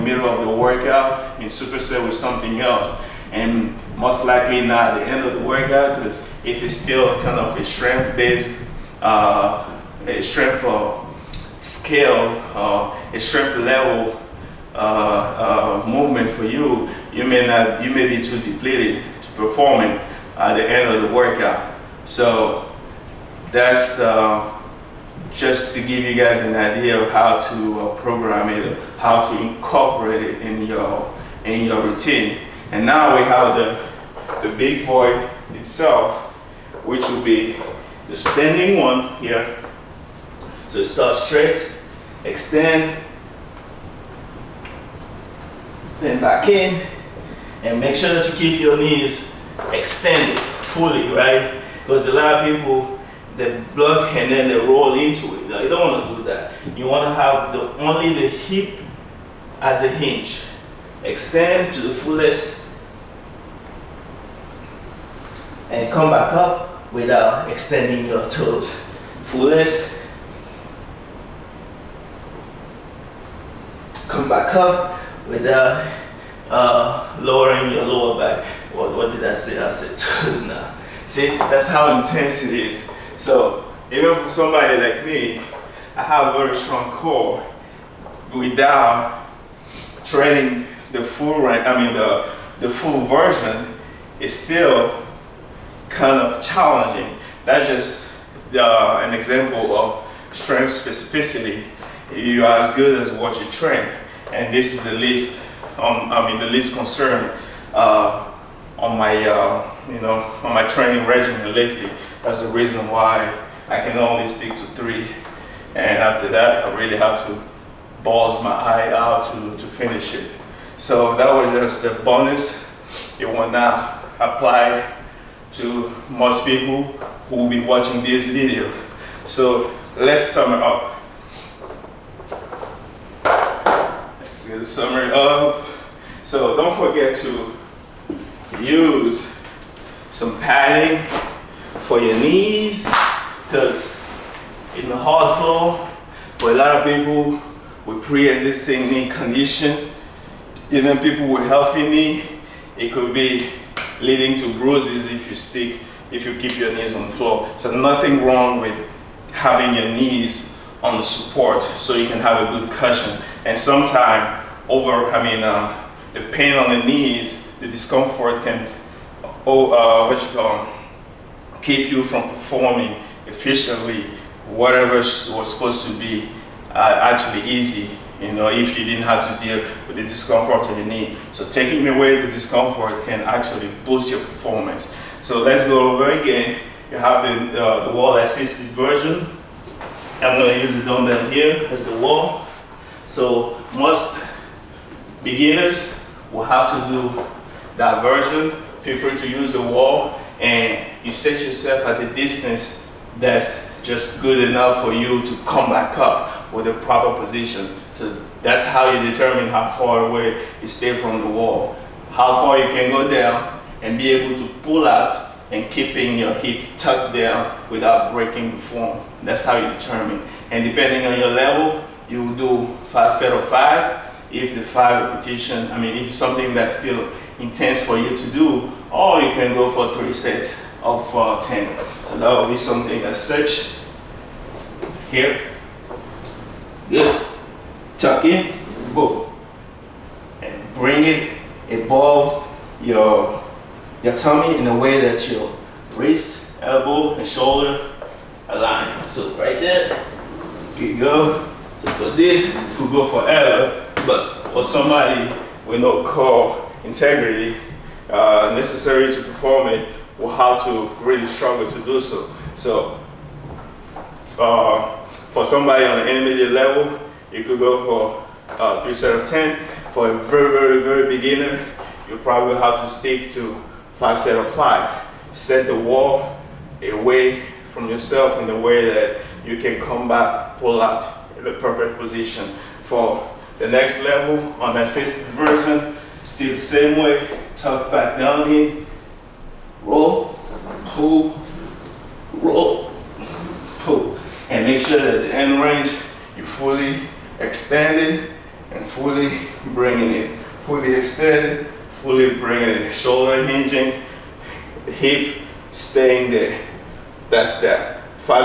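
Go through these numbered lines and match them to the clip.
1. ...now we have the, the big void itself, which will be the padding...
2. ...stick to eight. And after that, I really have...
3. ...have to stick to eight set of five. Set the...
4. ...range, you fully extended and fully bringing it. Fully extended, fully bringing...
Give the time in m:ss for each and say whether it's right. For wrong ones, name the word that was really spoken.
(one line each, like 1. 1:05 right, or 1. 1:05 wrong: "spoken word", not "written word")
1. 0:32 wrong: "standing", not "padding"
2. 1:54 wrong: "three", not "eight"
3. 4:32 wrong: "five", not "eight"
4. 4:55 right.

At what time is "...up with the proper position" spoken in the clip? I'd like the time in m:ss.
3:25.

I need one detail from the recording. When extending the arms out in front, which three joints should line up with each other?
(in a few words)
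wrist, elbow, and shoulder.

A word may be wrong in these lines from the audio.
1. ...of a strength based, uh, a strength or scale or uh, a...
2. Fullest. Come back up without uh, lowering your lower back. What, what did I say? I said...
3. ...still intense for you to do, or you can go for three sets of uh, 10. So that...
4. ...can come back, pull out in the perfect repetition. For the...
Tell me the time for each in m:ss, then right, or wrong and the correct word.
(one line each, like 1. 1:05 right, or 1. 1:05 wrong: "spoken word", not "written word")
1. 0:07 right
2. 1:09 right
3. 3:46 right
4. 4:39 wrong: "position", not "repetition".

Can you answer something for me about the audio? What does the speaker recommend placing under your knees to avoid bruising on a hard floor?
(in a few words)
padding.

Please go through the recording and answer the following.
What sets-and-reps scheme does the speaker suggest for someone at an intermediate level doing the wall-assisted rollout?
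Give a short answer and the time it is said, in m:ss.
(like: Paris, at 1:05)
3 sets of 10, at 4:28.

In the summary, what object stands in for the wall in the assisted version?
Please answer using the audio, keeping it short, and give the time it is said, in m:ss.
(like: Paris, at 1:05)
dumbbell, at 3:10.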